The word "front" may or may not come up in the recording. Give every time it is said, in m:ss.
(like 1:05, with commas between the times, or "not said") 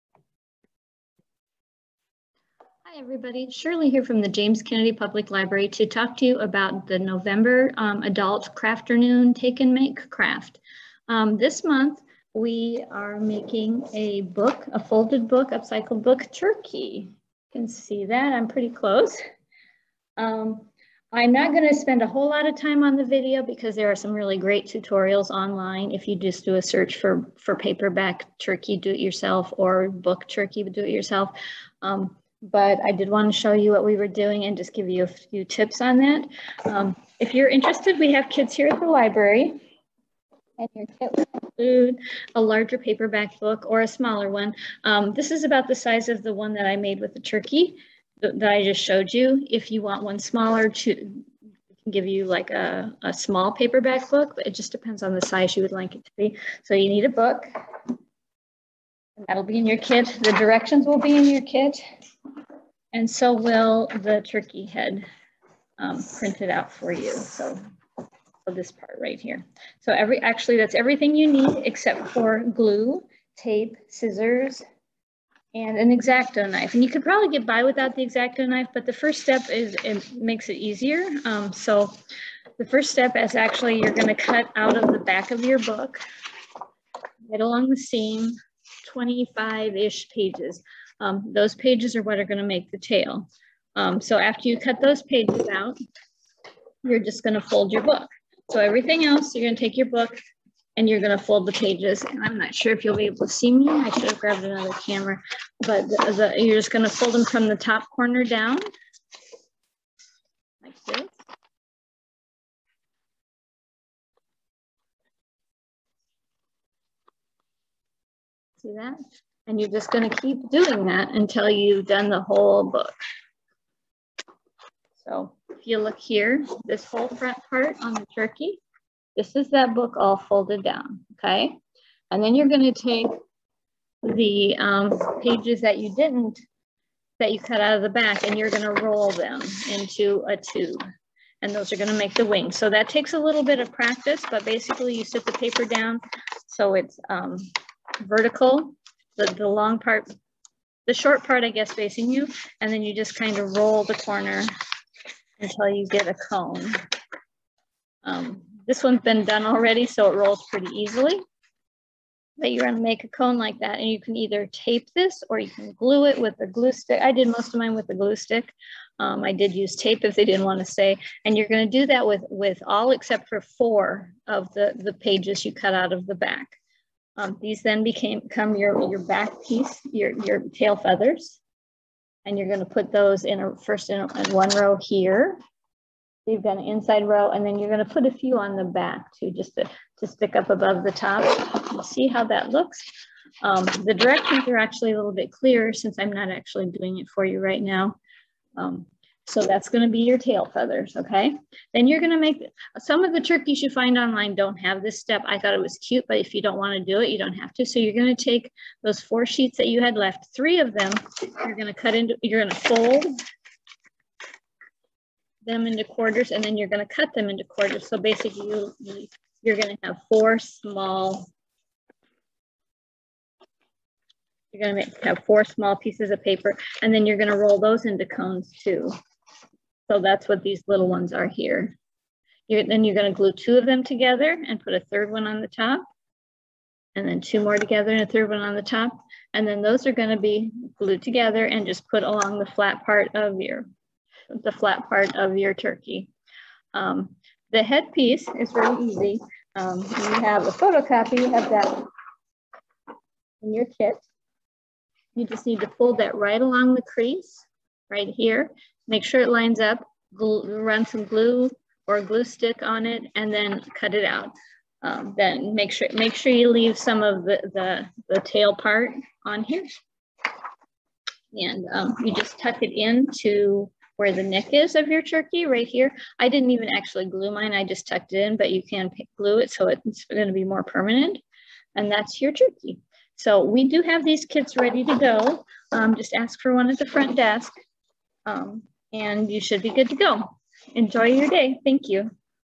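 2:07, 4:46.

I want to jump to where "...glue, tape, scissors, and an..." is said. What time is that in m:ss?
1:12.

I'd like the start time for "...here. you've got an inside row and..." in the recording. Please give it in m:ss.
3:04.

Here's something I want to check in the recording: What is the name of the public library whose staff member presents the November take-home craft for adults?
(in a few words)
James Kennedy Public Library.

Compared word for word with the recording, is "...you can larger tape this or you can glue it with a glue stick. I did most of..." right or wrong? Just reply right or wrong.
wrong.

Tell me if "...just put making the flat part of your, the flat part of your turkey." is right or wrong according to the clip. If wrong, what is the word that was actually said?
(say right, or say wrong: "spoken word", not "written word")
wrong: "along", not "making".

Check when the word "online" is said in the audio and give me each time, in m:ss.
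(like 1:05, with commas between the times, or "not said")
0:25, 3:23.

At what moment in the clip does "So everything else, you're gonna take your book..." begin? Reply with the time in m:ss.
1:38.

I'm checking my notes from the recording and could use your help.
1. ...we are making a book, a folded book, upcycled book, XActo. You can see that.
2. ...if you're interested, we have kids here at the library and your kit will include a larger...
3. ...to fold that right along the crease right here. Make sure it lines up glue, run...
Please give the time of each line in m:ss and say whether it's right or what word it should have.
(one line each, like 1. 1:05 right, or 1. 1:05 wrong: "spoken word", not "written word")
1. 0:12 wrong: "Turkey", not "XActo"
2. 0:37 right
3. 4:15 right.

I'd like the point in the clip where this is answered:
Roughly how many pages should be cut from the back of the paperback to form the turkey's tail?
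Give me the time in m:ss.
1:28.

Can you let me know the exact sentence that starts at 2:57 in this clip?
Um, these then became, become your, your back piece, your, your tail feathers.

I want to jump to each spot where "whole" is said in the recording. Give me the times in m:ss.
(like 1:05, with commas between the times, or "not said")
0:22, 2:02, 2:06.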